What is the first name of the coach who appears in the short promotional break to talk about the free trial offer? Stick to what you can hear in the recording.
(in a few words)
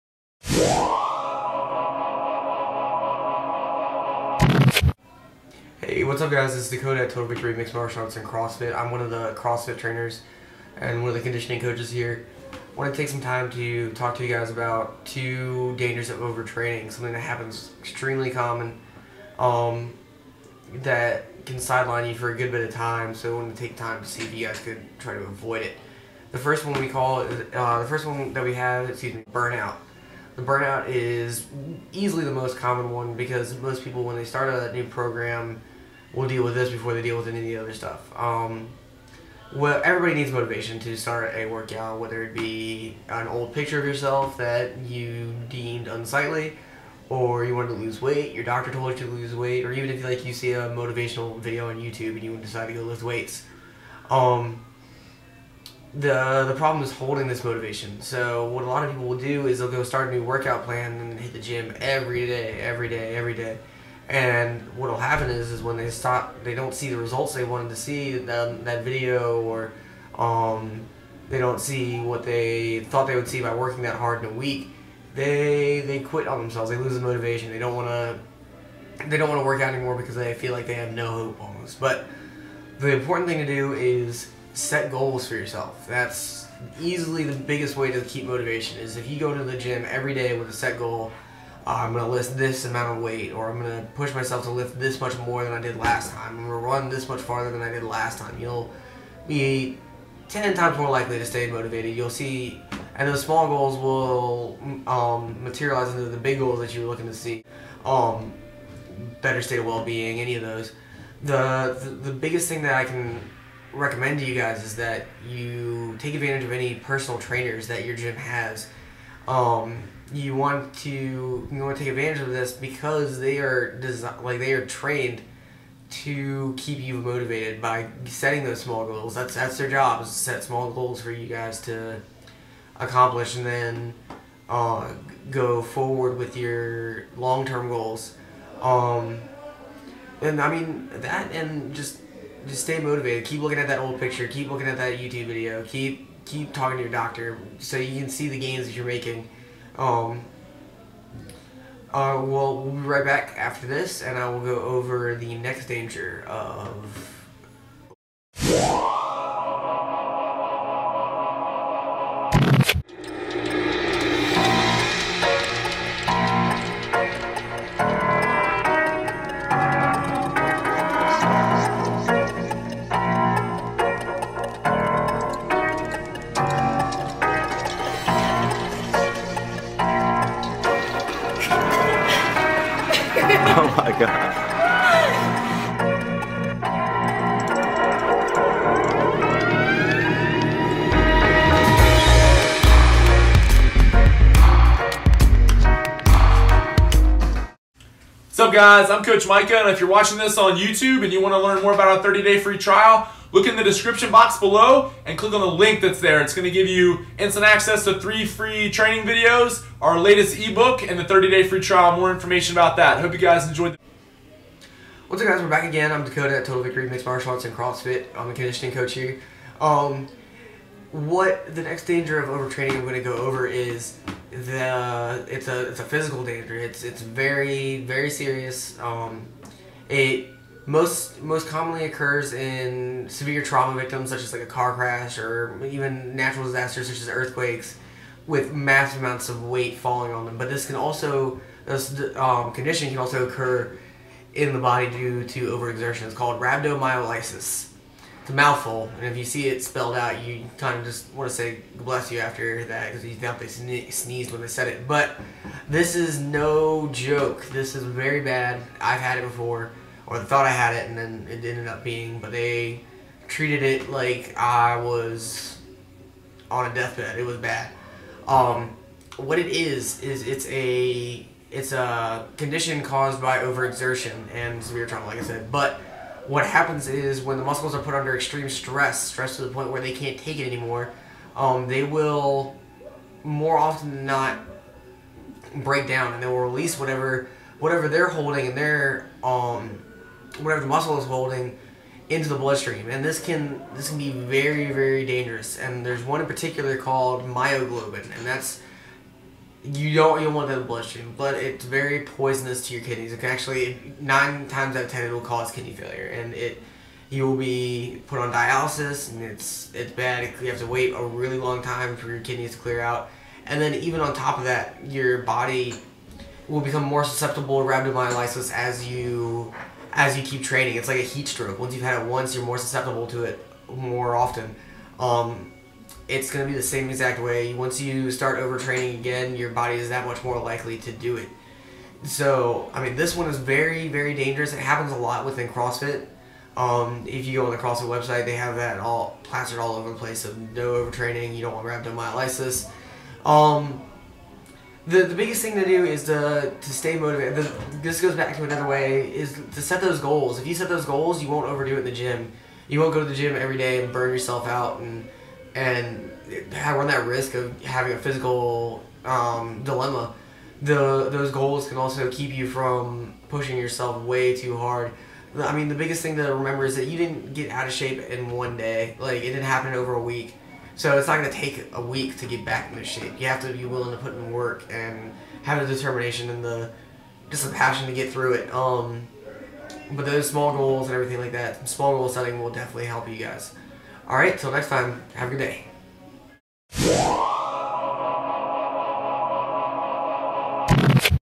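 Micah.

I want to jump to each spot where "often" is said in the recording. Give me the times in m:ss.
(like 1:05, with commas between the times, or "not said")
4:43, 5:24.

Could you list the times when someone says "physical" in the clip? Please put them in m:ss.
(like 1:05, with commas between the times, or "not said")
3:45, 5:57.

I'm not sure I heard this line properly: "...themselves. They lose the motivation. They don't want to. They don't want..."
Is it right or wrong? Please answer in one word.
right.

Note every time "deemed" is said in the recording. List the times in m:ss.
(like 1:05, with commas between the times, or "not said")
0:45.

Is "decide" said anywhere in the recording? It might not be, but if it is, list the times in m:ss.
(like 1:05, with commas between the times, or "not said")
0:52.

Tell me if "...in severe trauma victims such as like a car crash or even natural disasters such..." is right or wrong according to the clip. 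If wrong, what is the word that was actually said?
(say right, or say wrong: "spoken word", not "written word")
right.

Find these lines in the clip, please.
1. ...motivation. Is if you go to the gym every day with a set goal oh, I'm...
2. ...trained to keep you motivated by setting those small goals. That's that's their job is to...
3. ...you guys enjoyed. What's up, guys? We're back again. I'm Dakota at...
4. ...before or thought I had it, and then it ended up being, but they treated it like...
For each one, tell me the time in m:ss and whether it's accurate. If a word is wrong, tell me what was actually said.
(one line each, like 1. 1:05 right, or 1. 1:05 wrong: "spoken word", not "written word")
1. 1:28 right
2. 2:04 right
3. 3:33 right
4. 4:19 right.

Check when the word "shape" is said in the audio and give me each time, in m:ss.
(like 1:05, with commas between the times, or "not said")
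6:07, 6:12.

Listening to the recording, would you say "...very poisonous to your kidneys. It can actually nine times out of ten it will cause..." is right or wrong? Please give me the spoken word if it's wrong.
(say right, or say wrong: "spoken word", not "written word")
right.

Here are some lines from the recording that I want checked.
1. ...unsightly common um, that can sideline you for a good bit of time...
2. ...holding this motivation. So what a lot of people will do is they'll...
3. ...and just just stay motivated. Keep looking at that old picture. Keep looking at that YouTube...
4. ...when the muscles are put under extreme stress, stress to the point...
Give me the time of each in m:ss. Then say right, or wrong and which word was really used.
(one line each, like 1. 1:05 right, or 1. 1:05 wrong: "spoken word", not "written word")
1. 0:17 wrong: "extremely", not "unsightly"
2. 0:56 right
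3. 2:21 right
4. 4:37 right.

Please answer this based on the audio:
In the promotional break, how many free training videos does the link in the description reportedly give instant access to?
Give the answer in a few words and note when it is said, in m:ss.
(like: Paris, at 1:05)
3, at 3:28.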